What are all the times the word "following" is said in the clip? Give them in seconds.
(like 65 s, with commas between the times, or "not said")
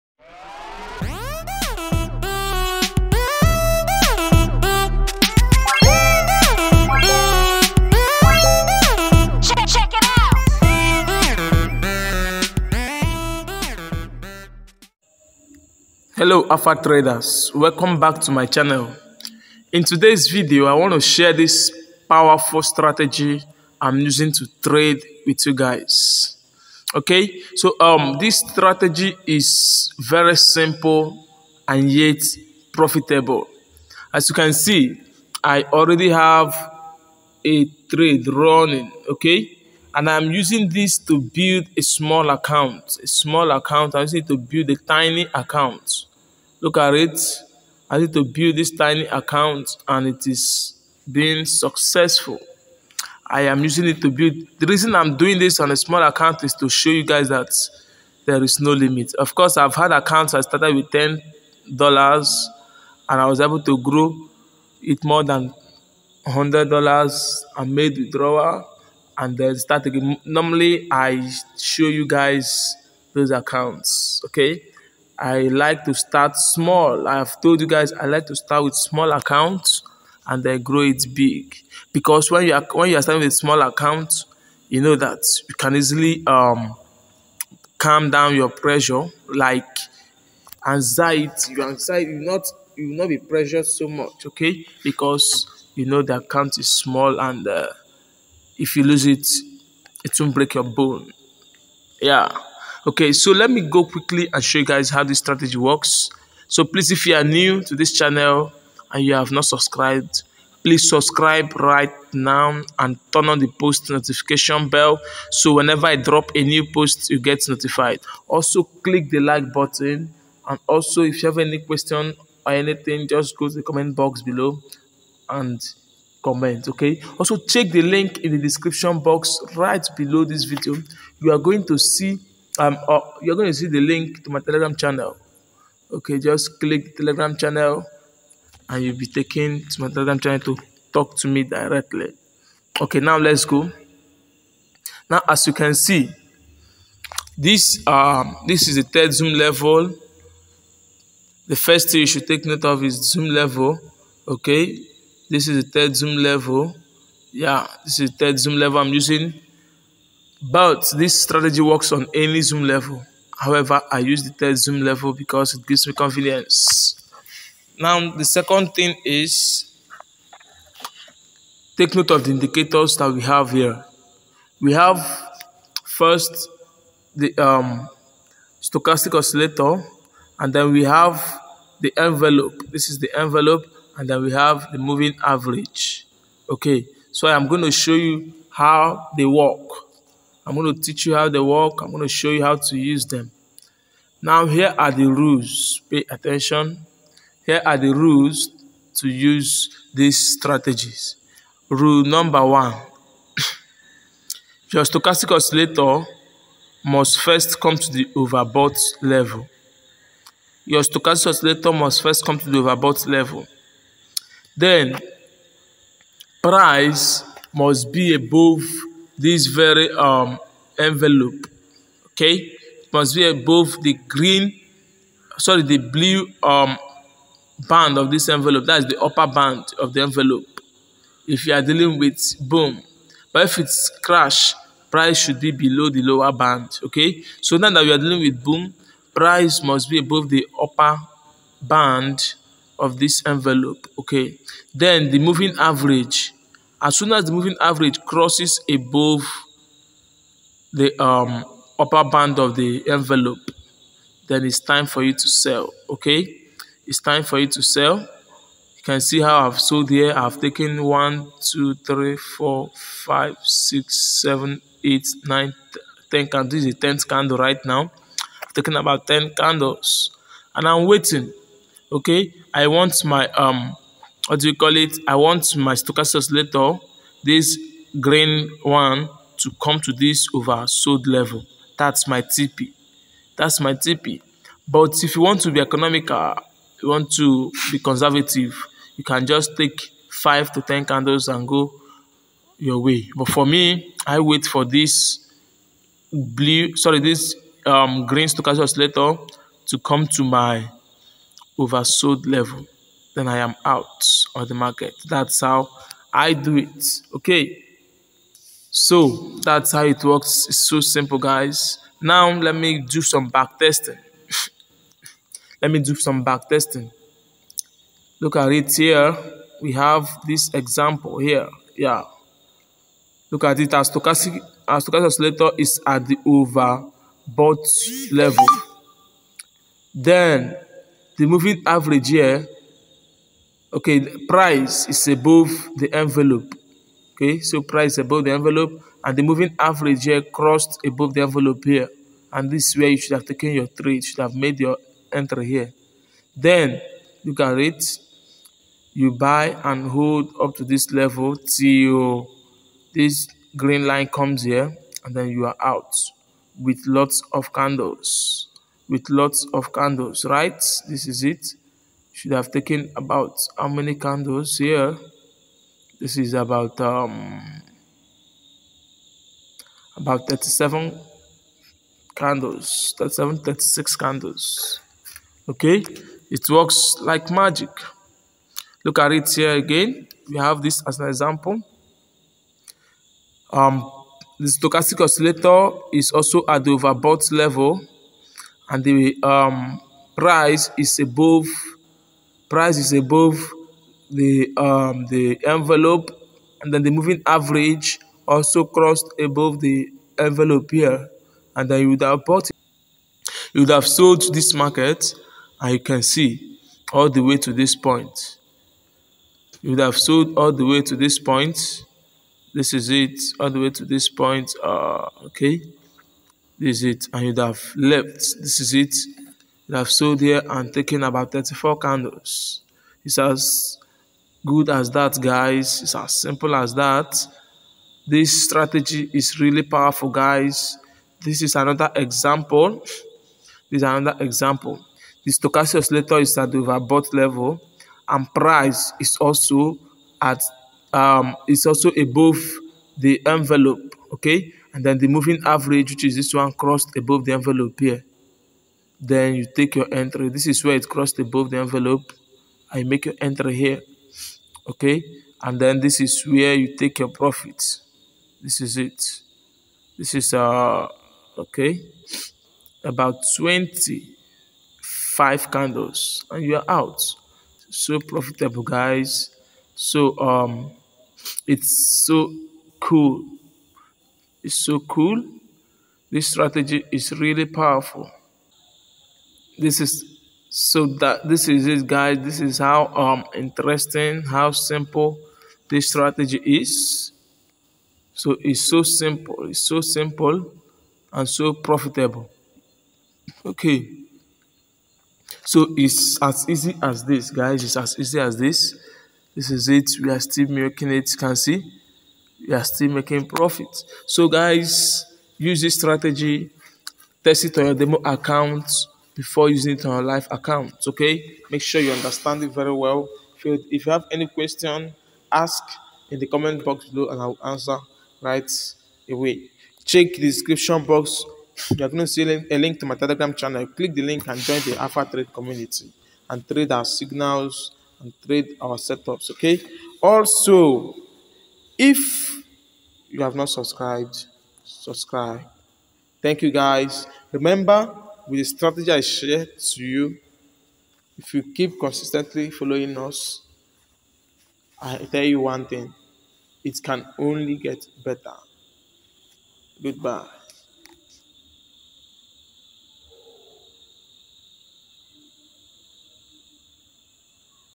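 542 s.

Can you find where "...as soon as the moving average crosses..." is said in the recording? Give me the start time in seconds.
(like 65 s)
246 s.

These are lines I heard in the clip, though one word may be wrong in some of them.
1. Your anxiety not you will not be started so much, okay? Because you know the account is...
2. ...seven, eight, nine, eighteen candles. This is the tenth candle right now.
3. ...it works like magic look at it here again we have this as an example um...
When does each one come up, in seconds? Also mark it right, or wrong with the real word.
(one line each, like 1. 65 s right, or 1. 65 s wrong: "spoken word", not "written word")
1. 91 s wrong: "pressured", not "started"
2. 264 s wrong: "ten", not "eighteen"
3. 376 s right.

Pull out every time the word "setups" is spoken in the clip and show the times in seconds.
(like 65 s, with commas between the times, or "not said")
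528 s.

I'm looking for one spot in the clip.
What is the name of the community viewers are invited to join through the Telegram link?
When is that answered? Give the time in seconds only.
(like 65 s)
524 s.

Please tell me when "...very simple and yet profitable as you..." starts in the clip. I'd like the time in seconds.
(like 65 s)
29 s.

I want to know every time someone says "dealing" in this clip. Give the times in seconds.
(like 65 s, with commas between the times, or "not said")
231 s, 237 s.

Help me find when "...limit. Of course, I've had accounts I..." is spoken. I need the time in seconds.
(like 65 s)
58 s.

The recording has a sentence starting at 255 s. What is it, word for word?
Okay, it's time for you to sell.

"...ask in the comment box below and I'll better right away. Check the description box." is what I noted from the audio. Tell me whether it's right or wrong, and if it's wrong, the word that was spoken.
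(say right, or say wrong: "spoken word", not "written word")
wrong: "answer", not "better".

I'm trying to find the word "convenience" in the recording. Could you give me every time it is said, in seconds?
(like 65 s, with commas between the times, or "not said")
165 s.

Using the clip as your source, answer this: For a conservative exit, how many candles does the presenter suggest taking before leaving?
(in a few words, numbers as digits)
5 to 10.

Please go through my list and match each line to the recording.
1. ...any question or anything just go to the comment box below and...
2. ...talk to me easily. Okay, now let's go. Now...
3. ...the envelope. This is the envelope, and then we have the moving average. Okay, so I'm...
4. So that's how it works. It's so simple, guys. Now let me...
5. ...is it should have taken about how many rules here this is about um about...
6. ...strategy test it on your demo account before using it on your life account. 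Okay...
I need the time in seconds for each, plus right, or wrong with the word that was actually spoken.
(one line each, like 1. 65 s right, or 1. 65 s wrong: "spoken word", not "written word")
1. 121 s right
2. 140 s wrong: "directly", not "easily"
3. 181 s right
4. 308 s right
5. 361 s wrong: "candles", not "rules"
6. 505 s right.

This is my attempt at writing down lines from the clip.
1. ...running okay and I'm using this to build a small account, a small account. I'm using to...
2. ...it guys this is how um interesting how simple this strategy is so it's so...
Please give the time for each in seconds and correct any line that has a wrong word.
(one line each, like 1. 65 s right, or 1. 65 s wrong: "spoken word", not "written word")
1. 38 s right
2. 481 s right.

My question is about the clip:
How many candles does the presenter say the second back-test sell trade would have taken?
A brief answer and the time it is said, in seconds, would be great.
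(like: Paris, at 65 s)
34, at 421 s.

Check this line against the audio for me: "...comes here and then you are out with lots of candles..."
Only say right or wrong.
right.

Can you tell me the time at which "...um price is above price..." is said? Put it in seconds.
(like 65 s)
389 s.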